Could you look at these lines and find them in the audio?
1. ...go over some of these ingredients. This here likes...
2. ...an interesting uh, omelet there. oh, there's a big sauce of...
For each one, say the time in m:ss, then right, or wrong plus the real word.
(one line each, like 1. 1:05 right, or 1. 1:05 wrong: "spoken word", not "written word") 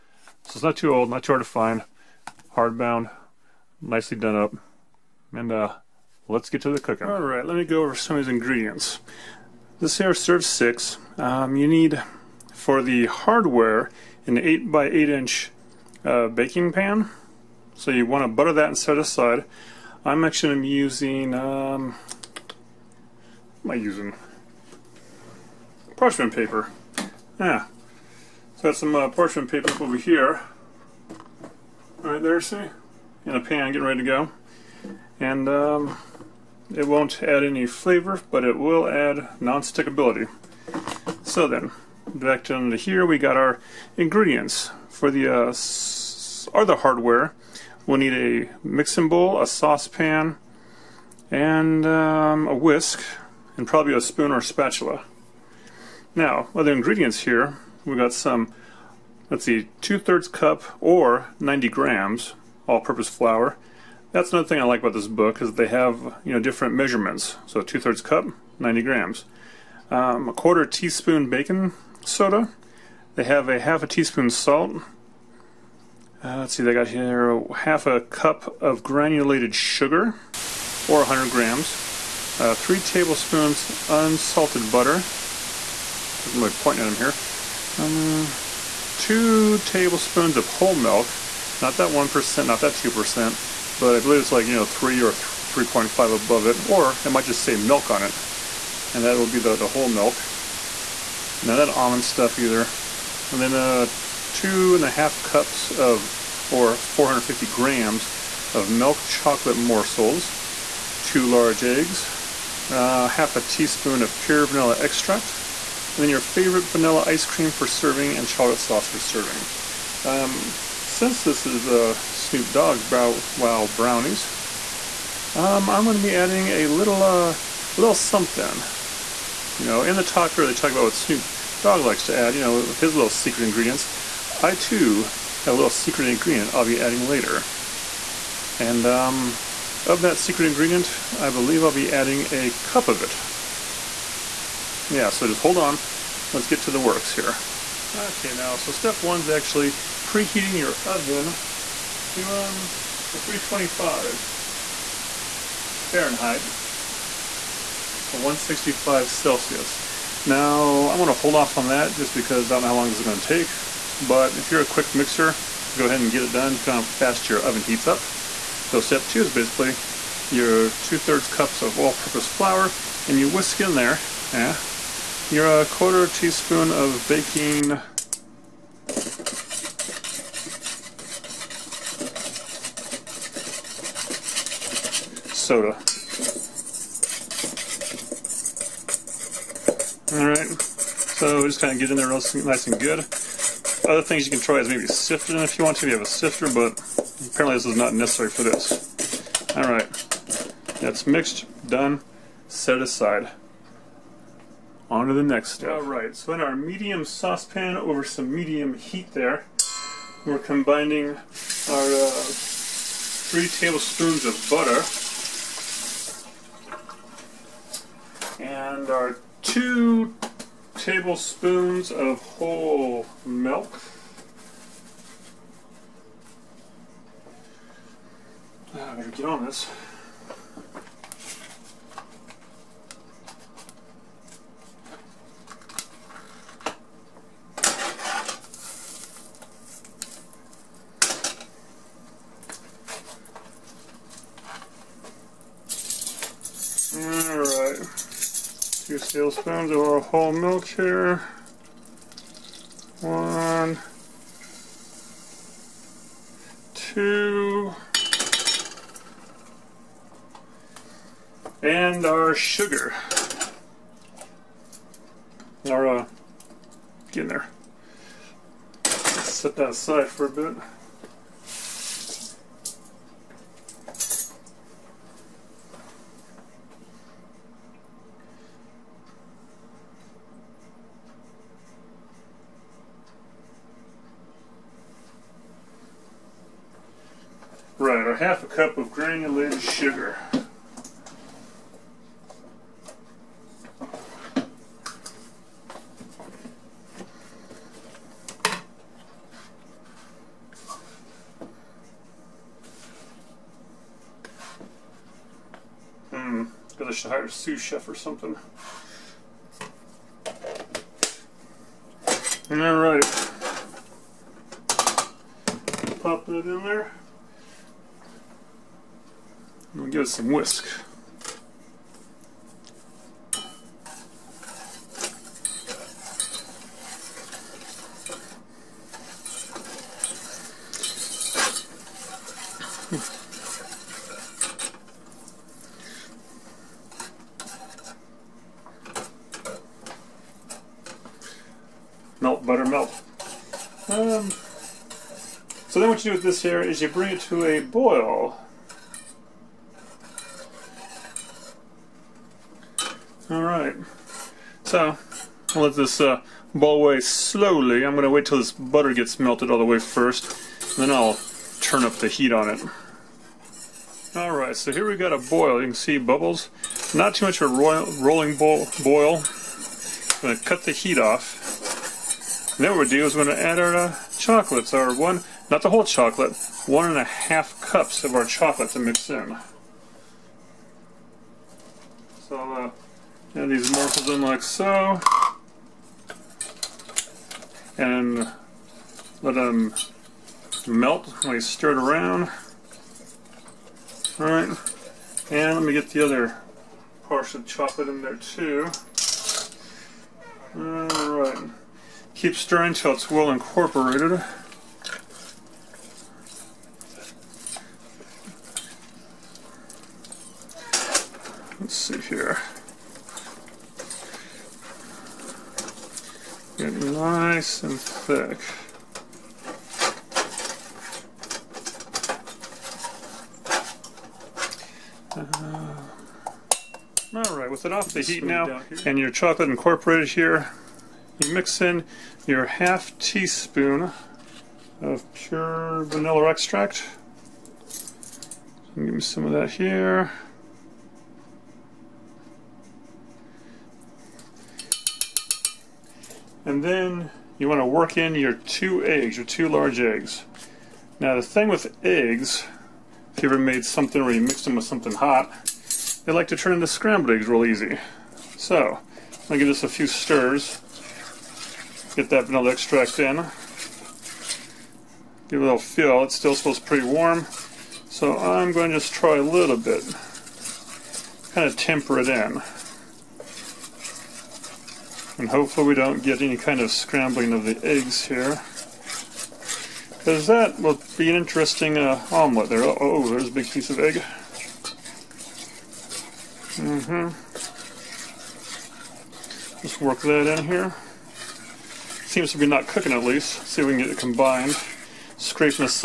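1. 0:07 wrong: "serves", not "likes"
2. 8:01 wrong: "piece", not "sauce".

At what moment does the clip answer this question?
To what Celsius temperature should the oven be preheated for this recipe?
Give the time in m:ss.
2:38.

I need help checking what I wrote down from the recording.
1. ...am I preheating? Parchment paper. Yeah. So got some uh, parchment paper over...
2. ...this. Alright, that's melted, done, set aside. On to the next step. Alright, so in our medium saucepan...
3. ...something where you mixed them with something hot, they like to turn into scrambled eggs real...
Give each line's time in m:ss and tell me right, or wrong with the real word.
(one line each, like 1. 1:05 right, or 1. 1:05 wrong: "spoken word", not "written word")
1. 0:23 wrong: "using", not "preheating"
2. 3:18 wrong: "mixed", not "melted"
3. 7:33 right.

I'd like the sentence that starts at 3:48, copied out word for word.
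I am gonna get on this.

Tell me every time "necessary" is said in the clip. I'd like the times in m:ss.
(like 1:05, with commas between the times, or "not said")
3:17.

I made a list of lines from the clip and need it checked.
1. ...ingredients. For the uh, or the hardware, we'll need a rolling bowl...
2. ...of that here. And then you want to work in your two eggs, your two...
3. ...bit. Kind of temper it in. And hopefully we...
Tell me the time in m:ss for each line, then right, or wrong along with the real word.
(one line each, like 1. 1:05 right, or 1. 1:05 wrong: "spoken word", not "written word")
1. 0:43 wrong: "mixing", not "rolling"
2. 7:19 right
3. 7:49 right.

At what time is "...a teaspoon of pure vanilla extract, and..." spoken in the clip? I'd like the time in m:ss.
1:53.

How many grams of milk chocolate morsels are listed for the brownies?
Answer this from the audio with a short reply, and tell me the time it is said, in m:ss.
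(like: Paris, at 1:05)
450 grams, at 1:46.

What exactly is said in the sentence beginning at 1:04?
That's another thing I like about this book is they have, you know, different measurements.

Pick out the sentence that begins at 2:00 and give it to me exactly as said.
Um, since this is uh, Snoop Dogg's Bow Wow Brownies, um, I'm going to be adding a little, uh, a little something.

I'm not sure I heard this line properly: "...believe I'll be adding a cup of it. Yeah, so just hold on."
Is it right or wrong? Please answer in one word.
right.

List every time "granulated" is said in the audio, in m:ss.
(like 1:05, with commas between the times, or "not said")
1:18, 4:48.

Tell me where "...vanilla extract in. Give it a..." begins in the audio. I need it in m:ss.
7:42.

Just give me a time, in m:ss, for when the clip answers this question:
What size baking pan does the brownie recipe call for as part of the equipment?
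0:14.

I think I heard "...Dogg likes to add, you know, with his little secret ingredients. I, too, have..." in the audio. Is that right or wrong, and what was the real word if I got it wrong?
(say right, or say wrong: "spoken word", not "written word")
right.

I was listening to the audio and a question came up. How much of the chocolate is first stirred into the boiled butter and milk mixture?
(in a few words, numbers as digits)
1.5 cups.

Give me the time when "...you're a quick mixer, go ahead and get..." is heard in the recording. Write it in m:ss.
2:44.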